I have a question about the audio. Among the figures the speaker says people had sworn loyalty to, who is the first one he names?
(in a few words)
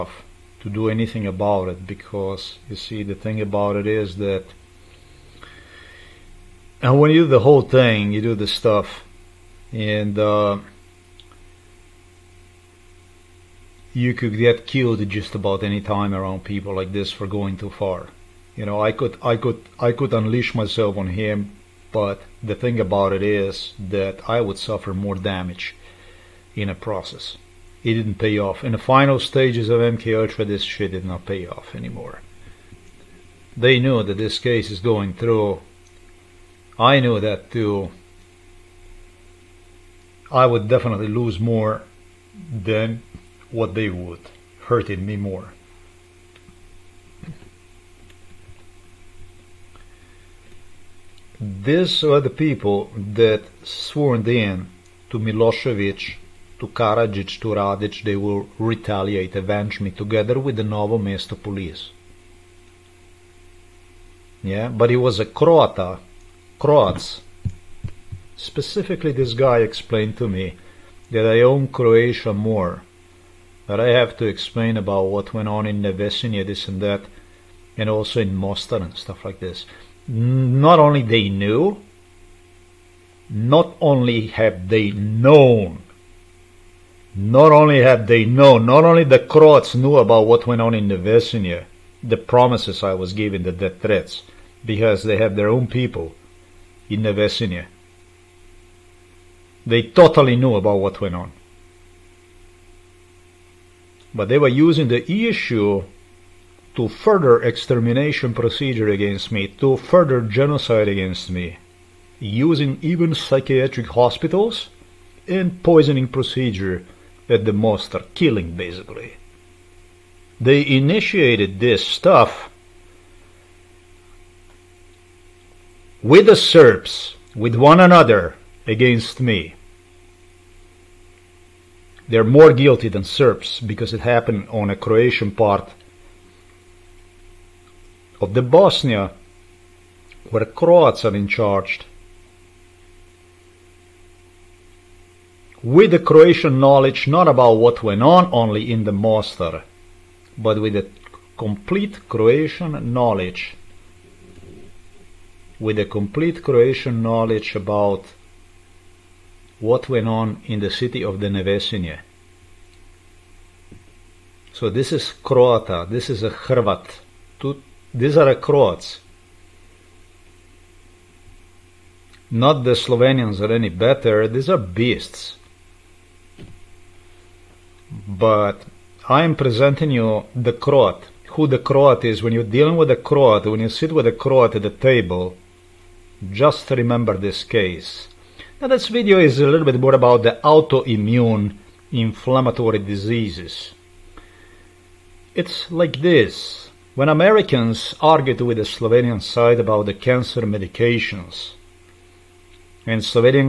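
Milosevic.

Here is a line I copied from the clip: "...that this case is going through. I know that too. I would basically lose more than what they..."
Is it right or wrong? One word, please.
wrong.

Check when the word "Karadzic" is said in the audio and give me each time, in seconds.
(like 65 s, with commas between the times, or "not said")
56 s.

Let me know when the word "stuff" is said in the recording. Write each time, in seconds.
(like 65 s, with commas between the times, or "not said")
8 s, 78 s, 121 s.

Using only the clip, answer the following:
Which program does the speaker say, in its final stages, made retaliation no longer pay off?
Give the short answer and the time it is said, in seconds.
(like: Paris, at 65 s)
MK Ultra, at 29 s.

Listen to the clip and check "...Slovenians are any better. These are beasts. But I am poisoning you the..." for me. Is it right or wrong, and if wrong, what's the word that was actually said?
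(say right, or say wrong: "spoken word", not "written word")
wrong: "presenting", not "poisoning".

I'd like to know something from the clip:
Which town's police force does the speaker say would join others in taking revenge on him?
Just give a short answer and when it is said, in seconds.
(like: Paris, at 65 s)
Novo Mesto, at 60 s.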